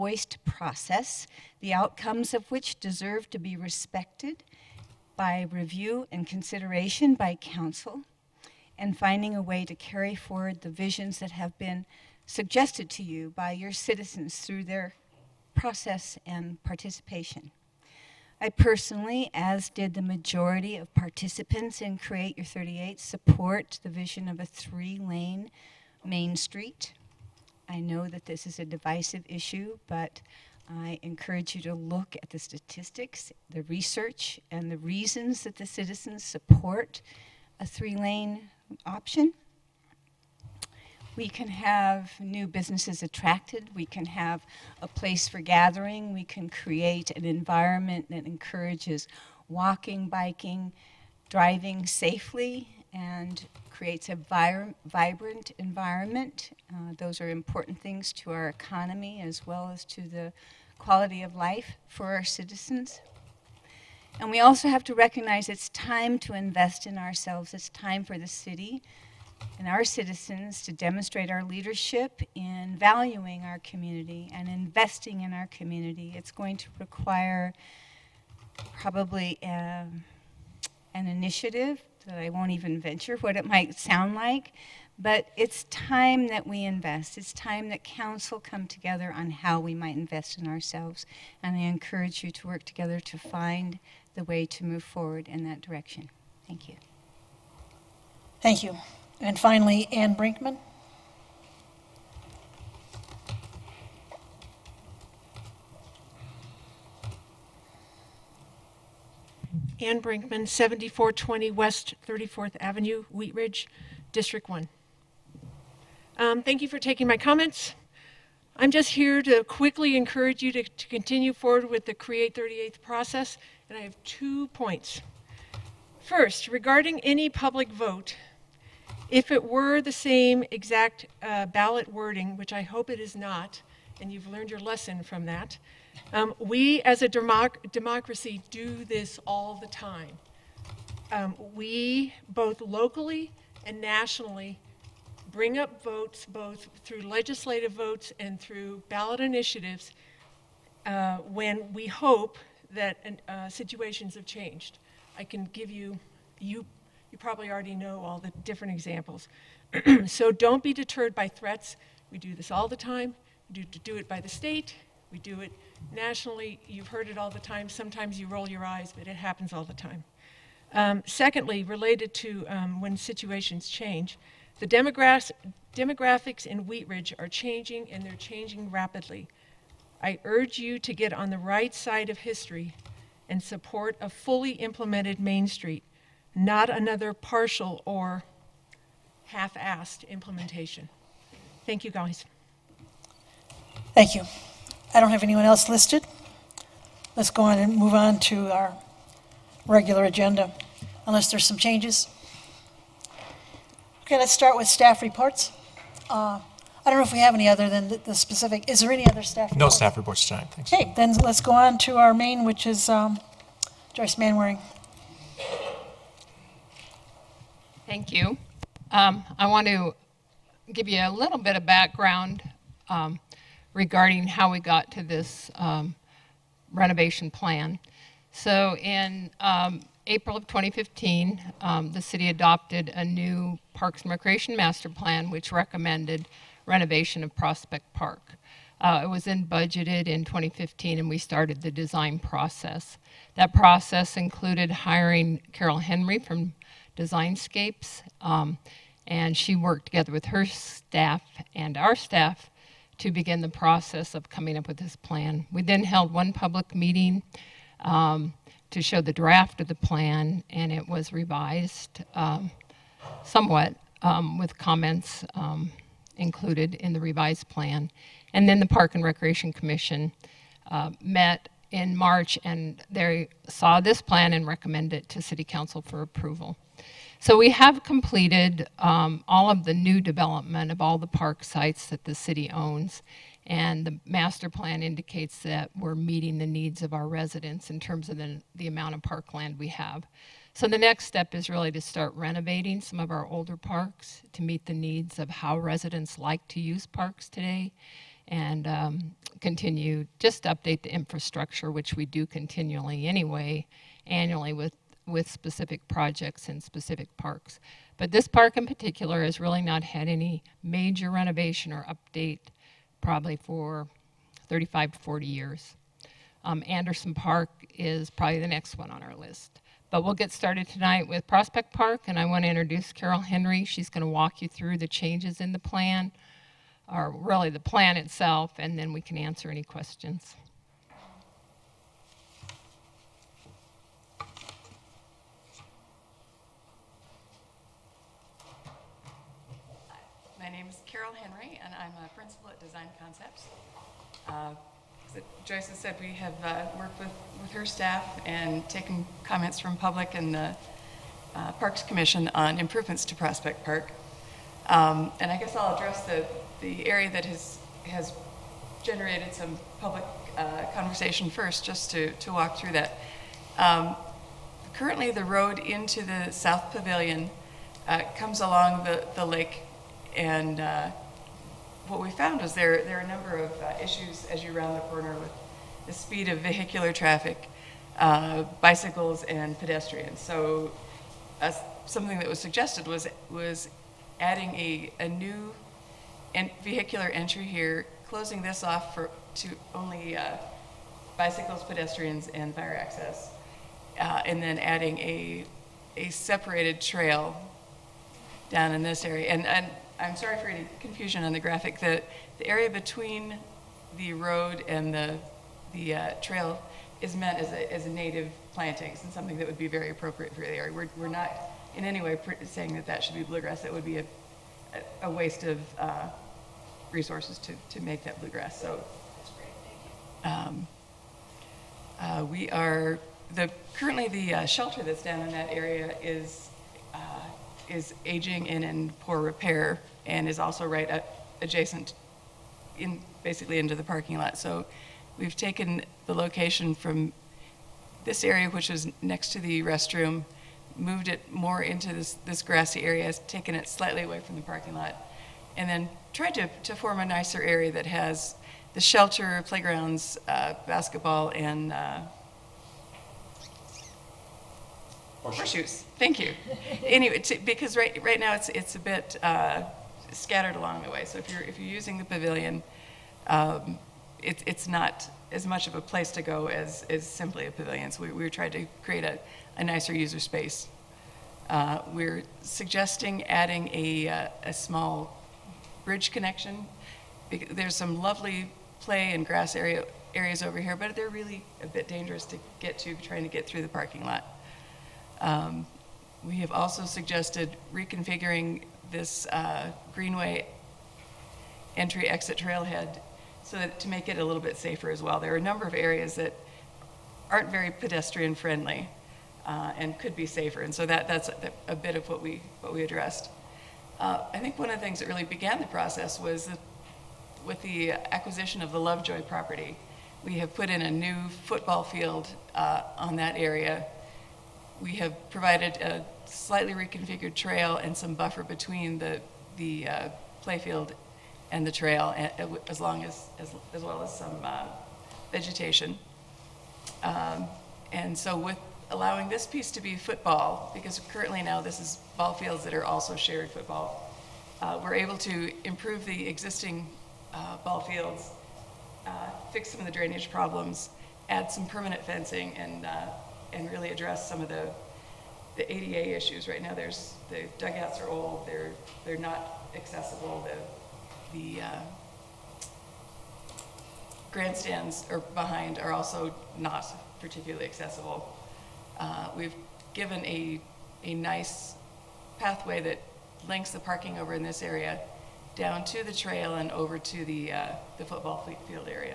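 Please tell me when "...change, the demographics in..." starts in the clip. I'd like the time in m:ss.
2:53.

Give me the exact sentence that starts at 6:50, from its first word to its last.
We're, we're not in any way saying that that should be bluegrass.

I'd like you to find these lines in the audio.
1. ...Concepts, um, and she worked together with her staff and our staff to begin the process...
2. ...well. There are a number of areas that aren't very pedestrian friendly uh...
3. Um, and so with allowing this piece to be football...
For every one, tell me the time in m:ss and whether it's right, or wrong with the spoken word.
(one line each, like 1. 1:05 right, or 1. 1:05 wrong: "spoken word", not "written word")
1. 4:07 right
2. 8:15 right
3. 8:47 right.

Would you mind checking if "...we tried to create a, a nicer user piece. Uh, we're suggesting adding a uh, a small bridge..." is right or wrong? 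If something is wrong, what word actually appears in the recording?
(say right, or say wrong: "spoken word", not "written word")
wrong: "space", not "piece".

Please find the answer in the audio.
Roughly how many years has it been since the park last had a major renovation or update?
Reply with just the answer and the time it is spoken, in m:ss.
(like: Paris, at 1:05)
35 to 40 years, at 5:14.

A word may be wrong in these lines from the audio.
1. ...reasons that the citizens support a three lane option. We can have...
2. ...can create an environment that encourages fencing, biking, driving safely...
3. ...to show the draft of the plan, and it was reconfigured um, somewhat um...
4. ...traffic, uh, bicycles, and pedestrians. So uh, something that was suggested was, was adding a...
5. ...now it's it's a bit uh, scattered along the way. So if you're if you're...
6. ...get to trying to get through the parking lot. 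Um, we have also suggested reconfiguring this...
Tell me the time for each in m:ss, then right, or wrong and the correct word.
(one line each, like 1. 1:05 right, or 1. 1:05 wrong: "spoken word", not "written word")
1. 0:34 right
2. 0:46 wrong: "walking", not "fencing"
3. 4:18 wrong: "revised", not "reconfigured"
4. 6:16 right
5. 7:38 right
6. 8:02 right.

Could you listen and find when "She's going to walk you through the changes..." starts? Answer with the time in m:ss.
5:23.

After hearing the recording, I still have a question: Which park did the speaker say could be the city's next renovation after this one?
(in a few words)
Anderson Park.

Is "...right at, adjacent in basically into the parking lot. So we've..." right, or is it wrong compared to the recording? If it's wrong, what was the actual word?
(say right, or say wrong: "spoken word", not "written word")
right.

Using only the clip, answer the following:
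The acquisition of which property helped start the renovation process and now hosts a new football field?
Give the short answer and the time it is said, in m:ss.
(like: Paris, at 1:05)
Lovejoy property, at 8:28.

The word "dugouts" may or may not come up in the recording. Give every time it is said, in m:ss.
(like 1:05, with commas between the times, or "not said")
9:07.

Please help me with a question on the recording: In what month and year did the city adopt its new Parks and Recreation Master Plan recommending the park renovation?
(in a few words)
April 2015.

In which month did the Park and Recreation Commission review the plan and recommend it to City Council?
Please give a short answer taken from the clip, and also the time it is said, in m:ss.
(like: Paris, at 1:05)
March, at 4:31.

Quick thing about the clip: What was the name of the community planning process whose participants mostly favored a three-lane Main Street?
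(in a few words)
Create Your 38.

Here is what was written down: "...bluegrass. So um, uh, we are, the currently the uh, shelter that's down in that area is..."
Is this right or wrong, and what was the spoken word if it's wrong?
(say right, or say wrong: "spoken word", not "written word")
right.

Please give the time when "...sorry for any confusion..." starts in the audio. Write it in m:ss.
6:40.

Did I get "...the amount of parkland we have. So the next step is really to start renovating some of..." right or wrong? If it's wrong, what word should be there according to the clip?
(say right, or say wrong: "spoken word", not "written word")
right.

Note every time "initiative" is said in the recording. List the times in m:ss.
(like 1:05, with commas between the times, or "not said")
1:21, 2:29.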